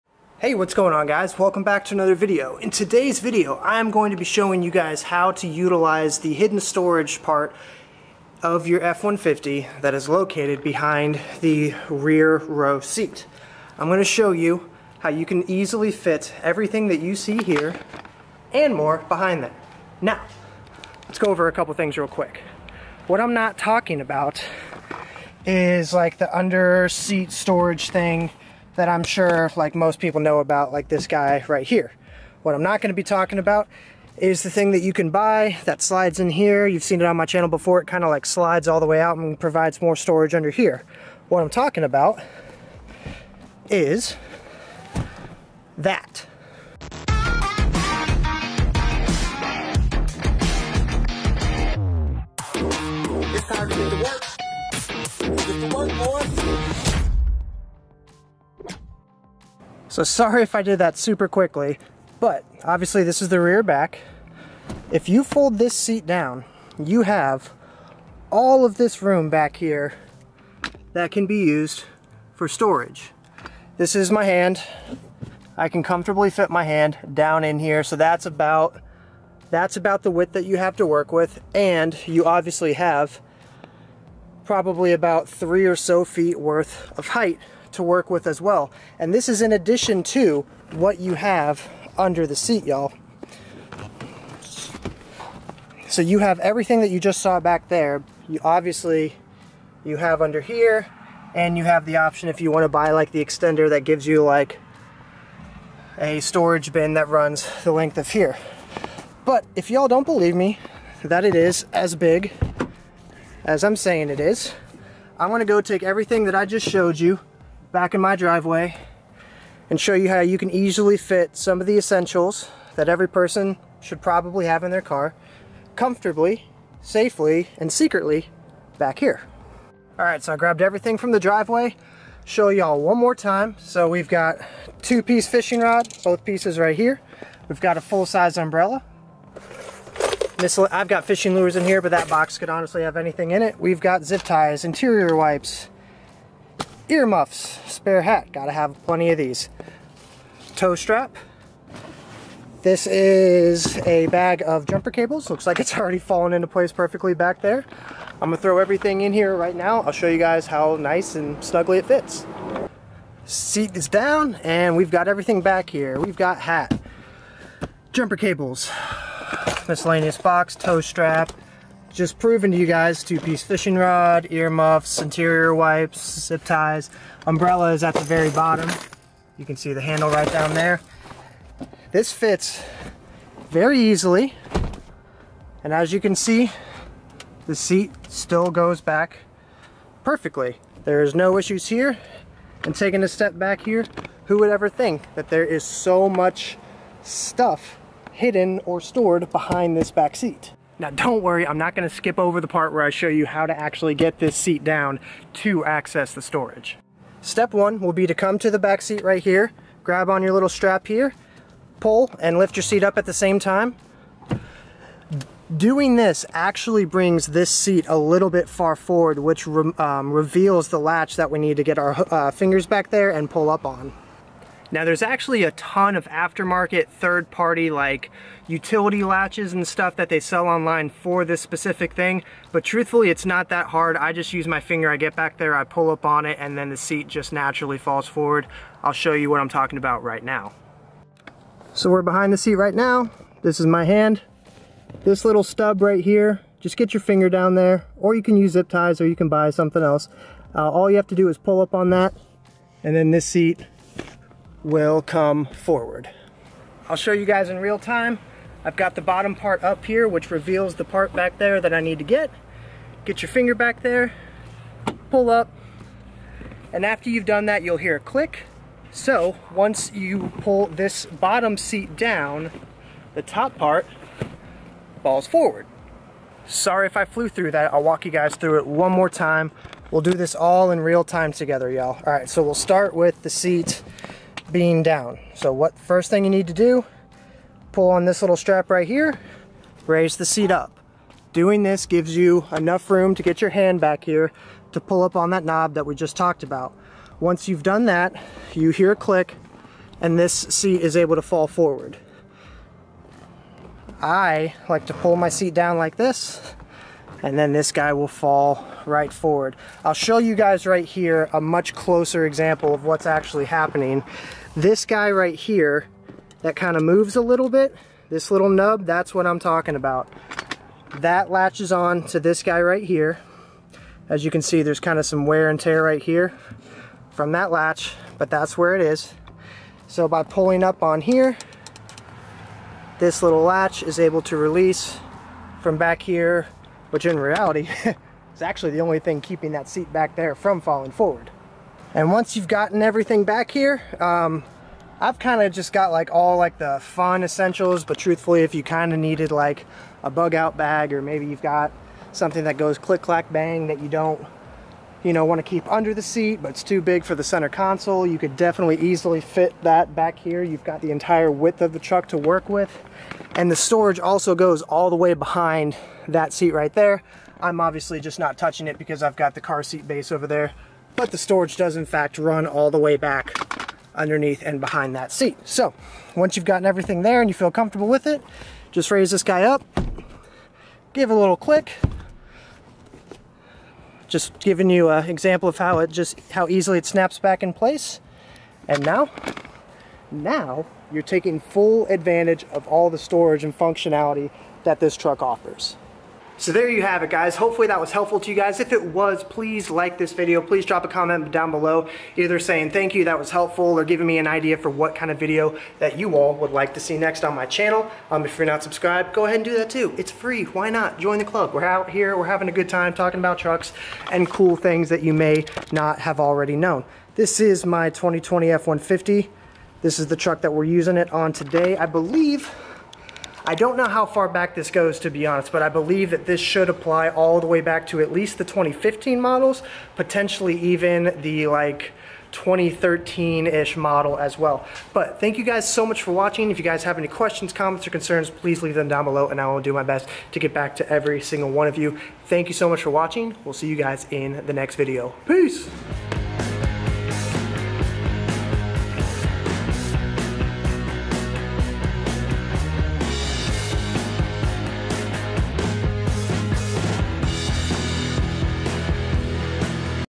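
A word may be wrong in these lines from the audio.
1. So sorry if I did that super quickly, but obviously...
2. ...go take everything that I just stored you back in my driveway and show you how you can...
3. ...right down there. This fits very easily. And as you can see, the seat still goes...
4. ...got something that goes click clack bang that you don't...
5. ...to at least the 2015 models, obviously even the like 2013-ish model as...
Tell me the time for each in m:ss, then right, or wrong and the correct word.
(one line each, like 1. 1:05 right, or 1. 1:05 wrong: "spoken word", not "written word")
1. 0:59 right
2. 1:55 wrong: "showed", not "stored"
3. 3:00 right
4. 5:51 right
5. 7:07 wrong: "potentially", not "obviously".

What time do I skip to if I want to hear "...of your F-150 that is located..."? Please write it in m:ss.
0:08.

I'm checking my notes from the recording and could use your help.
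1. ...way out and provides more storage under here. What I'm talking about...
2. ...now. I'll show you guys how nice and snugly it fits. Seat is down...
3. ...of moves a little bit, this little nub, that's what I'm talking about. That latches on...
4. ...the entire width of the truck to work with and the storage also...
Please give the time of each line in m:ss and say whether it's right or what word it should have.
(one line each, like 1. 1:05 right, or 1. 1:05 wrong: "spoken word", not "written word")
1. 0:38 right
2. 2:39 right
3. 5:16 right
4. 6:00 right.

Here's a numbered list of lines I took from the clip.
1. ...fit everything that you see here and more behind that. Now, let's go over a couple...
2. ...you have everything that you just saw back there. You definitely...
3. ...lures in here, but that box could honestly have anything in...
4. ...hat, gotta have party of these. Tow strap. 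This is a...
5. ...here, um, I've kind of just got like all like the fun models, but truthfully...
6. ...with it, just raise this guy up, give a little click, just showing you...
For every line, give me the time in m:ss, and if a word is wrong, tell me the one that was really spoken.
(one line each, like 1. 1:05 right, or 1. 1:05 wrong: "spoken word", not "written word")
1. 0:15 right
2. 1:36 wrong: "obviously", not "definitely"
3. 2:21 right
4. 2:28 wrong: "plenty", not "party"
5. 5:43 wrong: "essentials", not "models"
6. 6:17 wrong: "giving", not "showing".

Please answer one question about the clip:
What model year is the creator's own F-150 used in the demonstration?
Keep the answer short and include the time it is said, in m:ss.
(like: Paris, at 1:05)
2020, at 6:57.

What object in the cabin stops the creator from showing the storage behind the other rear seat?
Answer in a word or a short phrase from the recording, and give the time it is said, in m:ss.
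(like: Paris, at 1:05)
car seat base, at 6:09.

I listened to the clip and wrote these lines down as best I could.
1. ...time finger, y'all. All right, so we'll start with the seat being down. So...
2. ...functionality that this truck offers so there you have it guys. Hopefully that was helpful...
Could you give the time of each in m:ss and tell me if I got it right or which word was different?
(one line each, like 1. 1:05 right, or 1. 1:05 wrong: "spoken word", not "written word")
1. 4:41 wrong: "together", not "finger"
2. 6:33 right.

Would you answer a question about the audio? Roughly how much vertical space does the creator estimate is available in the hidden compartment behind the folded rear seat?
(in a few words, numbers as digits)
3 feet.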